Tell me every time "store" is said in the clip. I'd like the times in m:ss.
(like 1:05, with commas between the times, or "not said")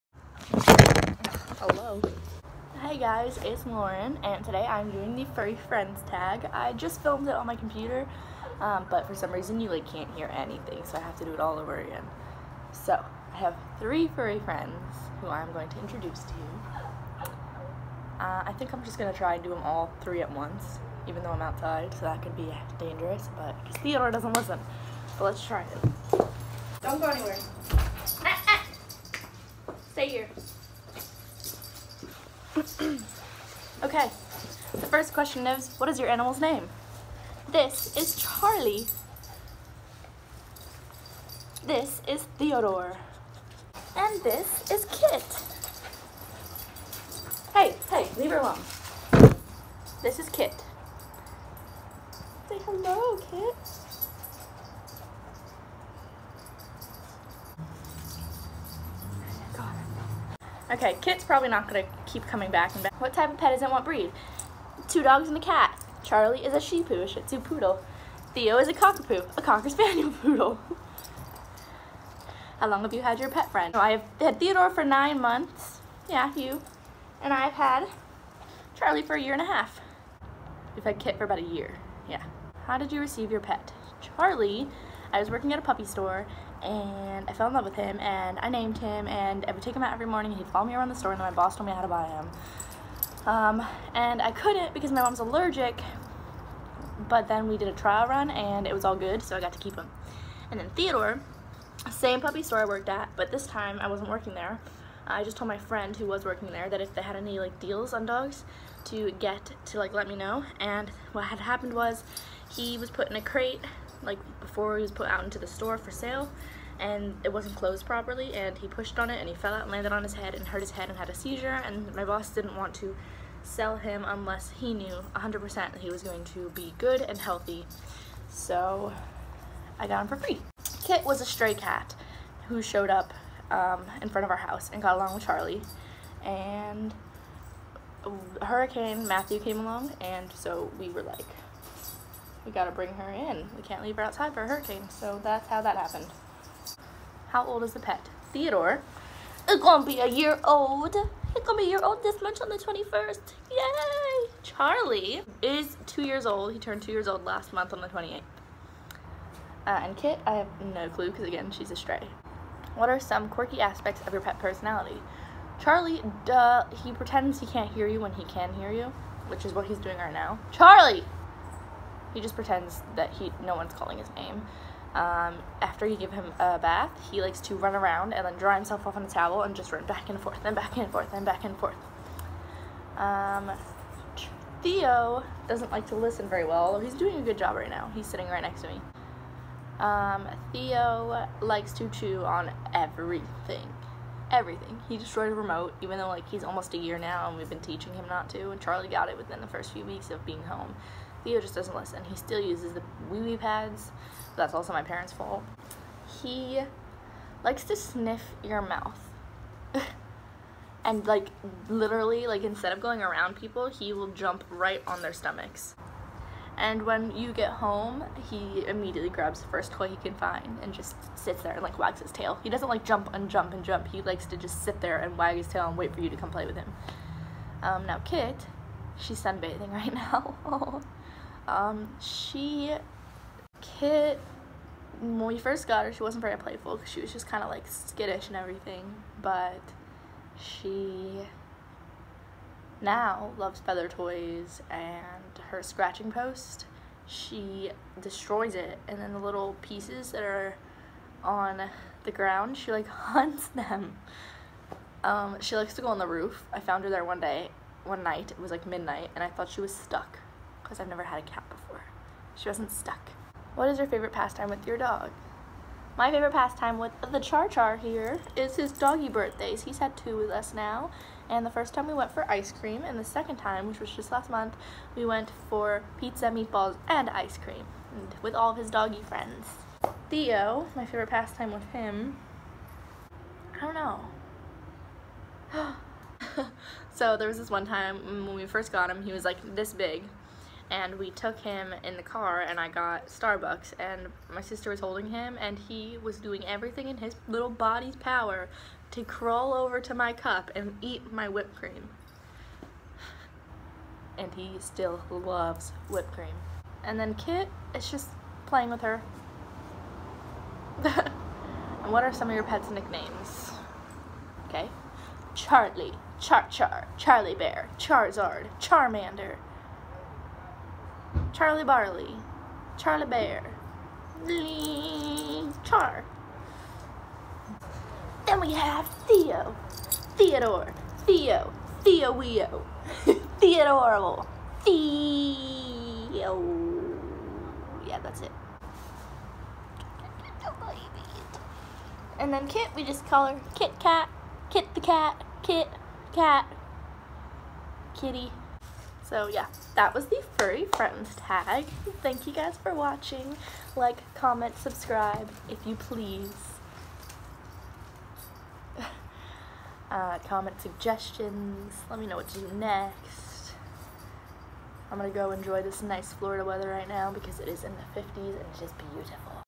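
1:25, 1:30, 1:42, 1:55.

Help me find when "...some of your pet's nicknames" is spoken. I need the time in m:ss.
5:12.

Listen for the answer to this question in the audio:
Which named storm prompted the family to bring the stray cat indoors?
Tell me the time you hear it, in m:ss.
2:18.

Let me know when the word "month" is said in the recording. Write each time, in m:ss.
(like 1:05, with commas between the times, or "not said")
1:15, 2:32, 2:37, 4:34.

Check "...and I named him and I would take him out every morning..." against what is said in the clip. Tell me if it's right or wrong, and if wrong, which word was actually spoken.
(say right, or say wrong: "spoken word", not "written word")
right.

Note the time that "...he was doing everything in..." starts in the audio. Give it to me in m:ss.
4:55.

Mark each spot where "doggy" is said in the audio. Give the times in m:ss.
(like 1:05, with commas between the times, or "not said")
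4:28, 4:38.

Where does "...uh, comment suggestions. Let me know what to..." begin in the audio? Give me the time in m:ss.
5:59.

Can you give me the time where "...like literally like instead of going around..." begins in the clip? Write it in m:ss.
3:31.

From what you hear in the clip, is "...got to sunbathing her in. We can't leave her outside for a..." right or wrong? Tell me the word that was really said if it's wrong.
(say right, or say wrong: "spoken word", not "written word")
wrong: "bring", not "sunbathing".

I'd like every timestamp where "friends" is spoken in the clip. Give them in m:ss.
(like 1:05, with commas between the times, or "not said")
0:05, 0:14, 1:13, 1:45, 4:39, 5:50.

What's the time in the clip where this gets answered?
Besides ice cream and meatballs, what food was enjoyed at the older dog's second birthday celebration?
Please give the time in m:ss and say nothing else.
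4:35.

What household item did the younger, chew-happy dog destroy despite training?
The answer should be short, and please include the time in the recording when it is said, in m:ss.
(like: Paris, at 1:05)
A remote, at 3:15.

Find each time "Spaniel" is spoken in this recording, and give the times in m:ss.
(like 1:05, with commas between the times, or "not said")
1:09.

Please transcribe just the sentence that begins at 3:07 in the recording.
He's sitting right next to me.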